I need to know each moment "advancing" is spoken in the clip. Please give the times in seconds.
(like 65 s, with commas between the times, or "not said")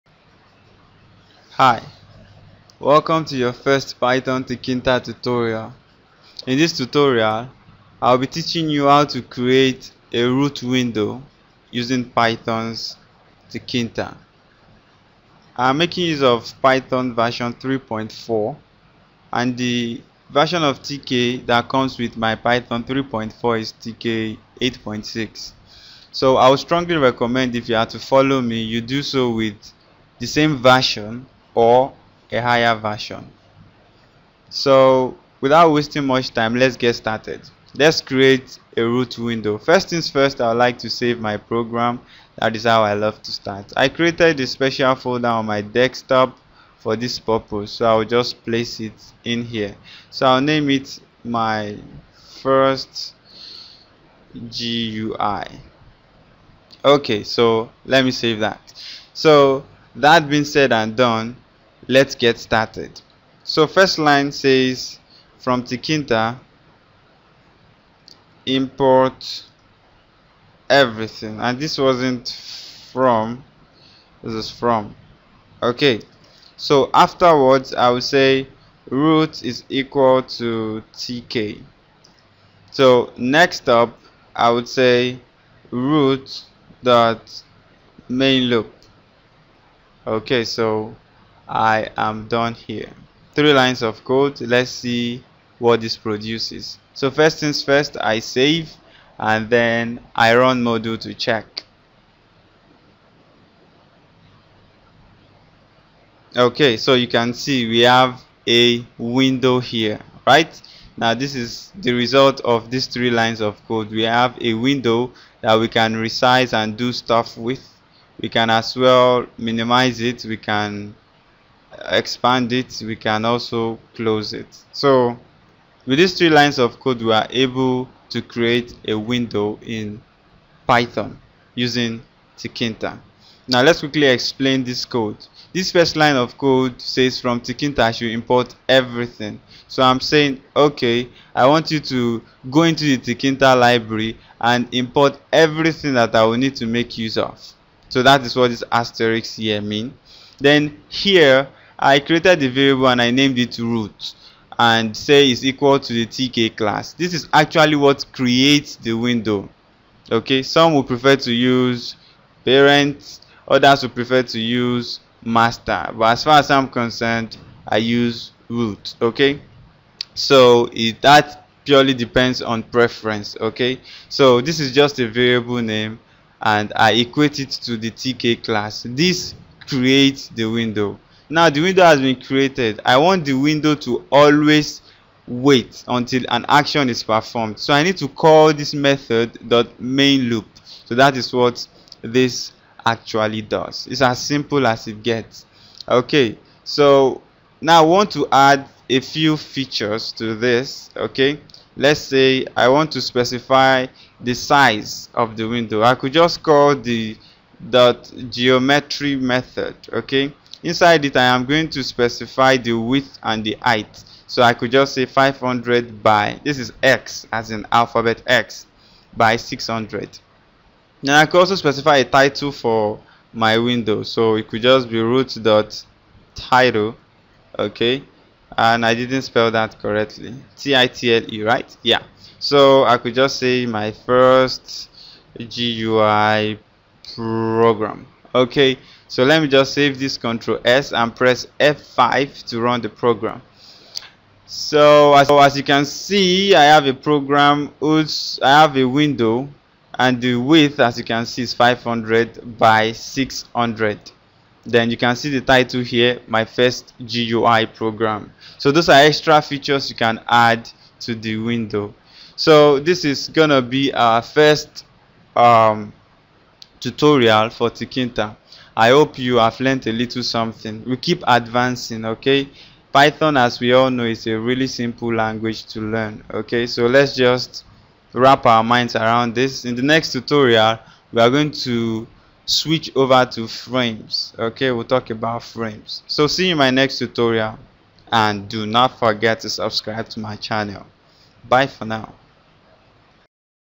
271 s.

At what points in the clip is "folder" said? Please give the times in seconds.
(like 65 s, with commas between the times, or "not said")
44 s.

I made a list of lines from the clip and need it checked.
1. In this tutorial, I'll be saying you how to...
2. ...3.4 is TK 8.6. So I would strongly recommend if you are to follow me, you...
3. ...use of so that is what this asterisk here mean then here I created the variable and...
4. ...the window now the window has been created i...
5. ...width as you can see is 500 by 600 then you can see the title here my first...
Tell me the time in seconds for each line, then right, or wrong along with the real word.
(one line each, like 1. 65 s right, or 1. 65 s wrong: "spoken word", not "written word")
1. 6 s wrong: "teaching", not "saying"
2. 22 s right
3. 146 s right
4. 180 s right
5. 250 s right.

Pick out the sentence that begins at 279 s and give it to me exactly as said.
In the next tutorial, we are going to switch over to frames, okay?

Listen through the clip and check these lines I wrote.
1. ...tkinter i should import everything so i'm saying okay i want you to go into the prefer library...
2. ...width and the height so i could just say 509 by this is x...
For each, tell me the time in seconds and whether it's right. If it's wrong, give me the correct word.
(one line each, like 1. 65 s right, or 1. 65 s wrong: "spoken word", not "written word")
1. 137 s wrong: "tkinter", not "prefer"
2. 212 s wrong: "500", not "509".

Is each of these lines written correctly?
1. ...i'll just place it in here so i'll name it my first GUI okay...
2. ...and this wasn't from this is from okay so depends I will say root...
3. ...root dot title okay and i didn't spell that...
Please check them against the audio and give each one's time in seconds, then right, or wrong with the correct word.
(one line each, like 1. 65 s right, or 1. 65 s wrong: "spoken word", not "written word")
1. 47 s right
2. 71 s wrong: "afterwards", not "depends"
3. 225 s right.